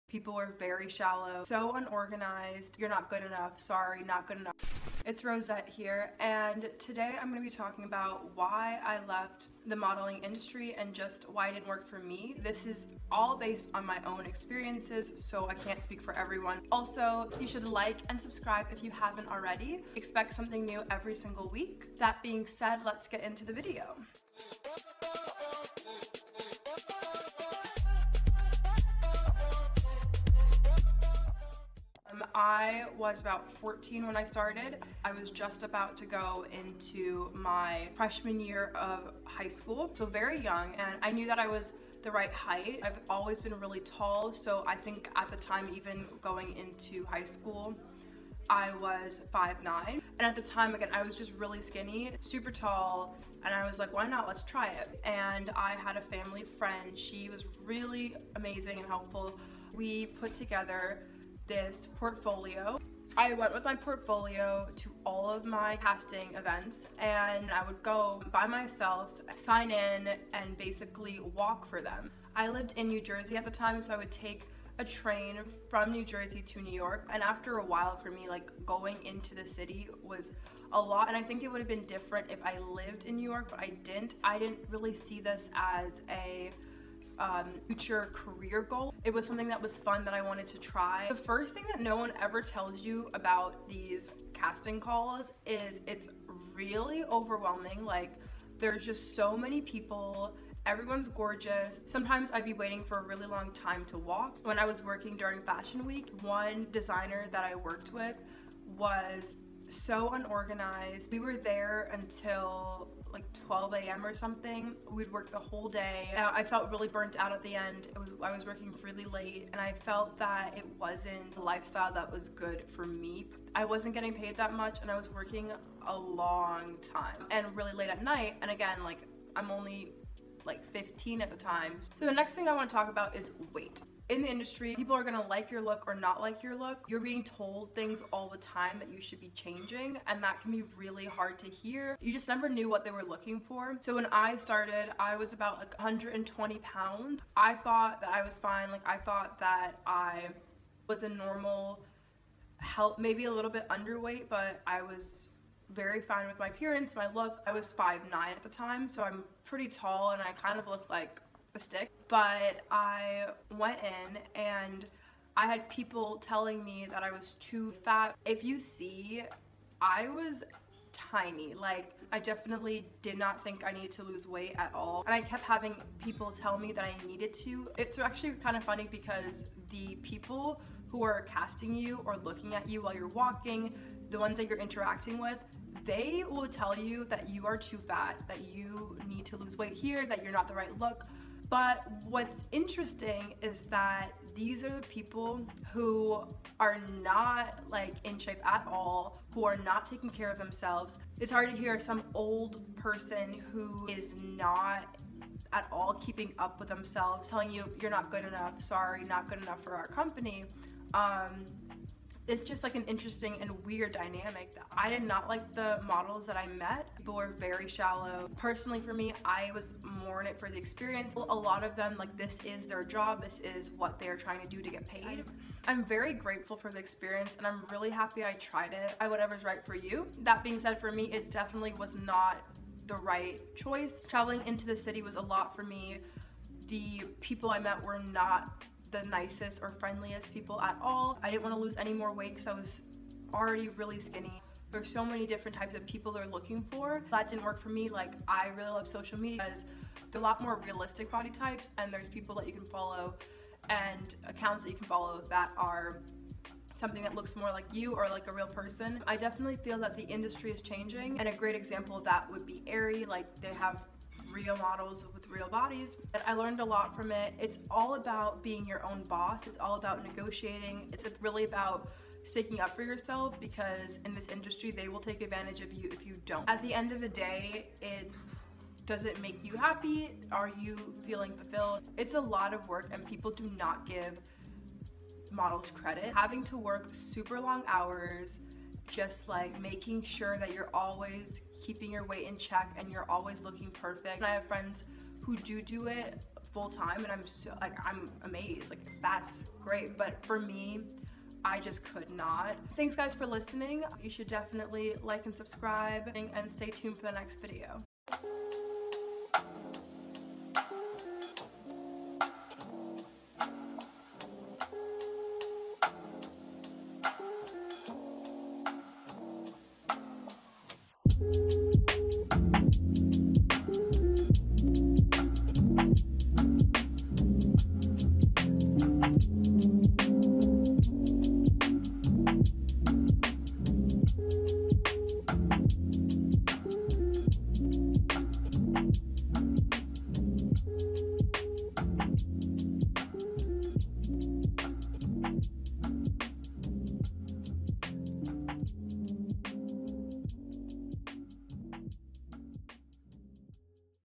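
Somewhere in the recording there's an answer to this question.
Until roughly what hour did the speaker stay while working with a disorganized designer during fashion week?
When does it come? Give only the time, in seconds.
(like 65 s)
113 s.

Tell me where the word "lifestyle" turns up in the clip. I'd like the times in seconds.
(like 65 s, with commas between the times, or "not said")
121 s.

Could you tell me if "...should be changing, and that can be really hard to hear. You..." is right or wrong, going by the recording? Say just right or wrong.
right.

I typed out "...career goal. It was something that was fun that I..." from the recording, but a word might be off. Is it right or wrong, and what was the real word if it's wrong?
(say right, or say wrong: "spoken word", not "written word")
right.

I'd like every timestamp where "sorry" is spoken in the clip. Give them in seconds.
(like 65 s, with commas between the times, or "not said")
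3 s, 208 s.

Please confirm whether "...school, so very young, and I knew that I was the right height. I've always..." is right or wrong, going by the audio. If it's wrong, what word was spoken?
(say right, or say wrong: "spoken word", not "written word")
right.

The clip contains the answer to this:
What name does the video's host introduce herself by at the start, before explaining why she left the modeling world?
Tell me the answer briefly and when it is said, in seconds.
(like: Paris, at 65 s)
Roset, at 5 s.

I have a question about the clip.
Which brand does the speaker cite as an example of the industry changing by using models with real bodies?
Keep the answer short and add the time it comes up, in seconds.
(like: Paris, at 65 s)
Aerie, at 262 s.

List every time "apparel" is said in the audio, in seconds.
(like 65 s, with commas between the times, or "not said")
not said.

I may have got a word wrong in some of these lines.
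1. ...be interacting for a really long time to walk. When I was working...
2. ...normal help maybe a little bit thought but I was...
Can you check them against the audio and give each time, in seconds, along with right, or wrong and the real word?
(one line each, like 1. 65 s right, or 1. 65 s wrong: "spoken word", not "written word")
1. 102 s wrong: "waiting", not "interacting"
2. 151 s wrong: "underweight", not "thought".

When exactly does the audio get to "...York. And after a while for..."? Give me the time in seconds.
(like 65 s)
76 s.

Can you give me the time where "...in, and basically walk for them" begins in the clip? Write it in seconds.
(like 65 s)
69 s.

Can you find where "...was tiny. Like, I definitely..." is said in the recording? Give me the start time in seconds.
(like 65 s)
170 s.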